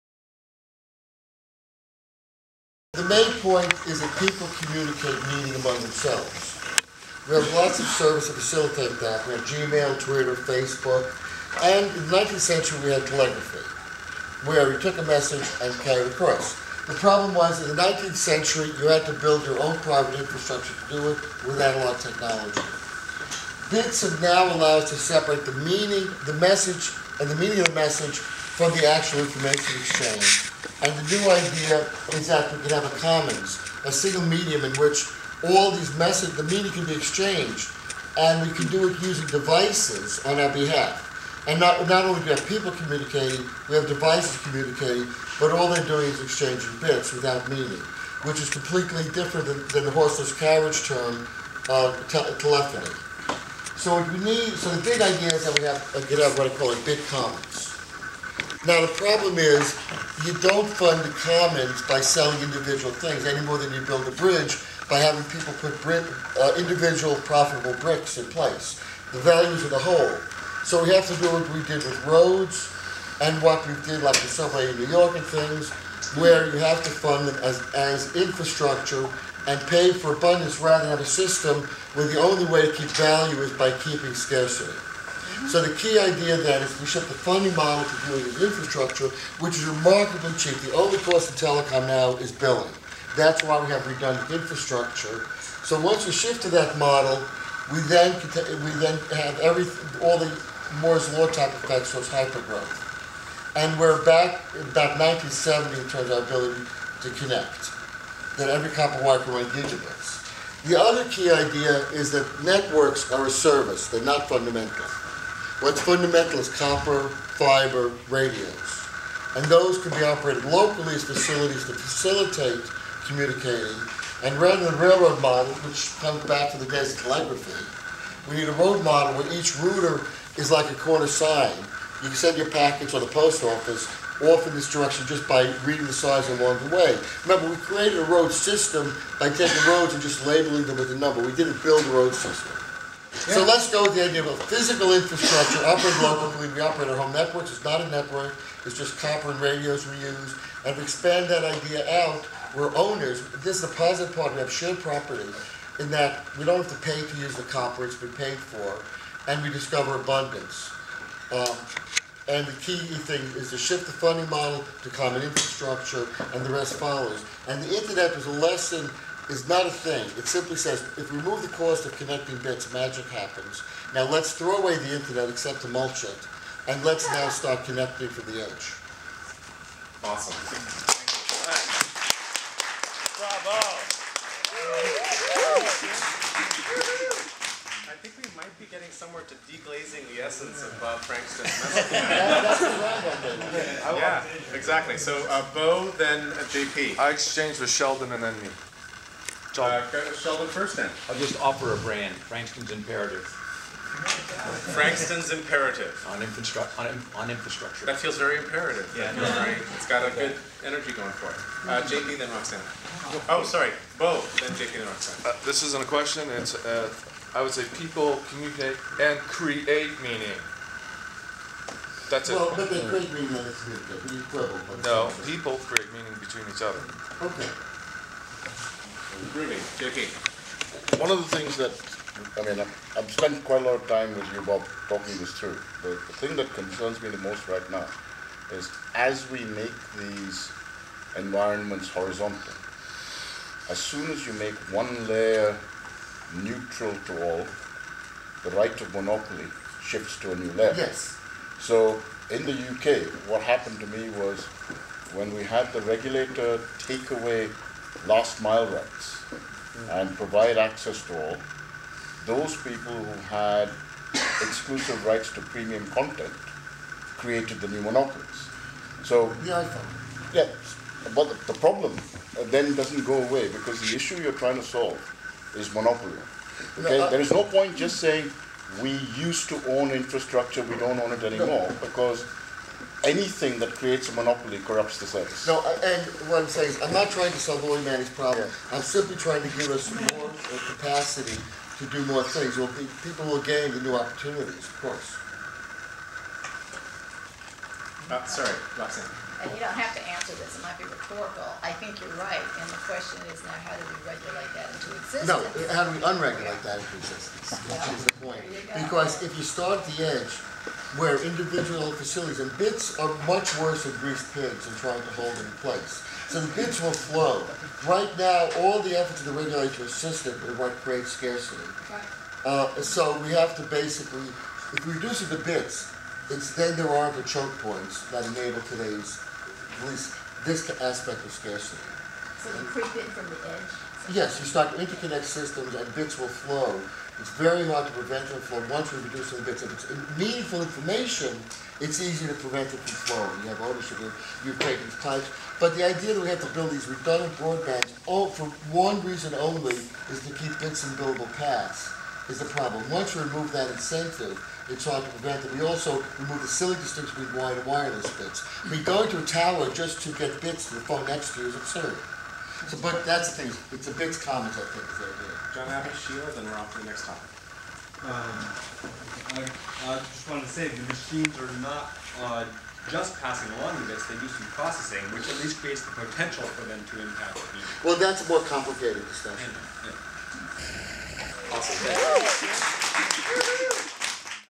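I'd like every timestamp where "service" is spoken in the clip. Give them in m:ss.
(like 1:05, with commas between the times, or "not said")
0:07, 1:53, 4:45.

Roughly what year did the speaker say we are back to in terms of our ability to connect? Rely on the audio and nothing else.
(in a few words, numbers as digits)
1970.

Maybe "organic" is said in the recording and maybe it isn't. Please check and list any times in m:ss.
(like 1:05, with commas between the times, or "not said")
not said.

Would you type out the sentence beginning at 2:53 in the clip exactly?
Now let's throw away the internet except to mulch it, and let's now start connecting from the edge.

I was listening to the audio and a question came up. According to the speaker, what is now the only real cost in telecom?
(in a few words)
Billing.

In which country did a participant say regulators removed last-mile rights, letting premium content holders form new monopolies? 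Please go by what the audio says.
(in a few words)
The UK.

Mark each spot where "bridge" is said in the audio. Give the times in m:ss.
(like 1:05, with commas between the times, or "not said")
1:04.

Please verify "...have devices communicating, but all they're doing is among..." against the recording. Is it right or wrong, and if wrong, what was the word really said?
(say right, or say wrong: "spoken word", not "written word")
wrong: "exchanging", not "among".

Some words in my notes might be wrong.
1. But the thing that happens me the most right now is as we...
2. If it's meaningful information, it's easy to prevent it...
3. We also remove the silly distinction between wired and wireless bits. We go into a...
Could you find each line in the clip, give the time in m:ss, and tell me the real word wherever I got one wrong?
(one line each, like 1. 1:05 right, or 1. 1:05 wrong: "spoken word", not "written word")
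1. 3:55 wrong: "concerns", not "happens"
2. 5:39 right
3. 5:55 right.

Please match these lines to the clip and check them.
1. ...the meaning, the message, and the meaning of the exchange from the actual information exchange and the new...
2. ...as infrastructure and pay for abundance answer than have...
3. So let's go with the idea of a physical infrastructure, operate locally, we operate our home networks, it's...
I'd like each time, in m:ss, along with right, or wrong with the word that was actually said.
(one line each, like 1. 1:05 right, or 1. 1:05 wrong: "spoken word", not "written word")
1. 0:25 wrong: "message", not "exchange"
2. 1:17 wrong: "rather", not "answer"
3. 2:23 right.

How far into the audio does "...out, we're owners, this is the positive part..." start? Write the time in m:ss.
2:32.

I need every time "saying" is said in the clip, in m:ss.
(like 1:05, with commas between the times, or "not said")
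4:37, 4:46.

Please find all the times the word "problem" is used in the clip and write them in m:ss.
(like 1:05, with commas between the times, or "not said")
0:16, 0:58, 4:31, 4:48, 5:52.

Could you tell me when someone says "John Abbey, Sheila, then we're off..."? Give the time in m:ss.
6:05.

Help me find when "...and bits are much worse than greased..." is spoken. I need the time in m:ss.
5:12.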